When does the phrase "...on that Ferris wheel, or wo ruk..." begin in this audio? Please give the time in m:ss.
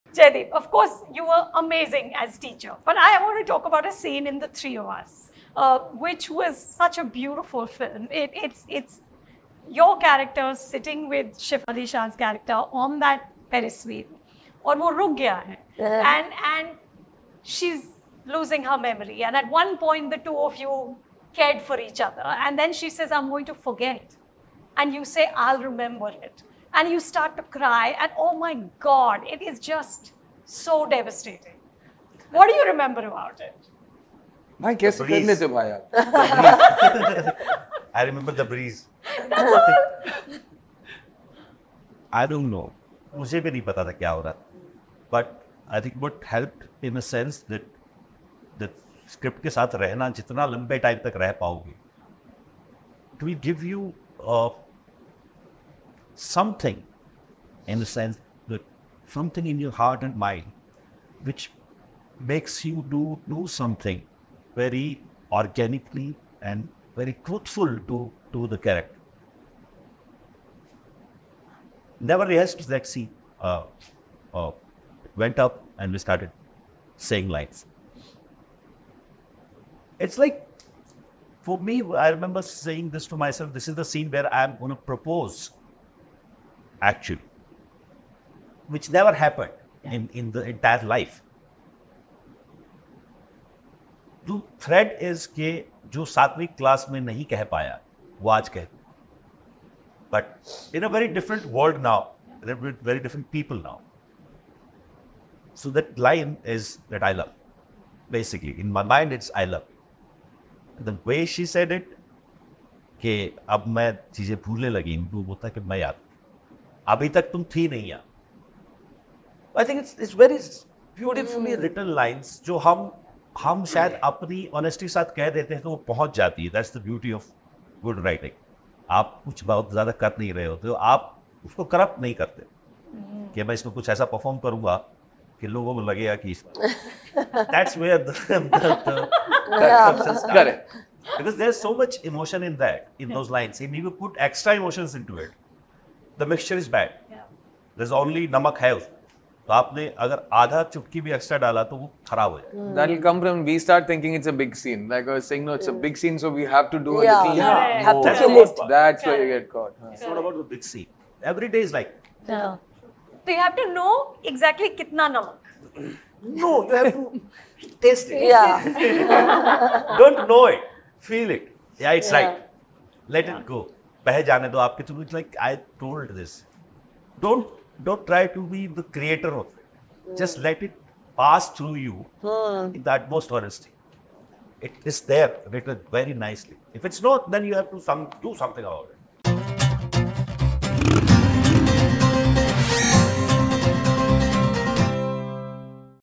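0:12.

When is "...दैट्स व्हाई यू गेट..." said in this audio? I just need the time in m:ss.
2:38.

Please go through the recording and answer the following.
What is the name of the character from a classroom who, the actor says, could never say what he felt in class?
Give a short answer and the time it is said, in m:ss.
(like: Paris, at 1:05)
Satvik, at 1:36.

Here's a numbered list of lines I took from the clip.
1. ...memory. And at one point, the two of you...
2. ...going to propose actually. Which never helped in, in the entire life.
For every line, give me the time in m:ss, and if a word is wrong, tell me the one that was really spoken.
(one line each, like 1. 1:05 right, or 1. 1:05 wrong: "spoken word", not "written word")
1. 0:18 right
2. 1:24 wrong: "happened", not "helped".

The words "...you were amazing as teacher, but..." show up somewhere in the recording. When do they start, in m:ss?
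0:01.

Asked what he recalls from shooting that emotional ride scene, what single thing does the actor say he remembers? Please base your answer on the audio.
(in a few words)
The breeze.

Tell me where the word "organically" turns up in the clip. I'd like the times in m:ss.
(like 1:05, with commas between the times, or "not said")
1:05.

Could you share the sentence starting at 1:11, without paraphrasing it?
Never rehearsed that uh, uh, went up and we started saying lines.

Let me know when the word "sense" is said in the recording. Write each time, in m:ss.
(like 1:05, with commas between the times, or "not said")
0:47, 0:57.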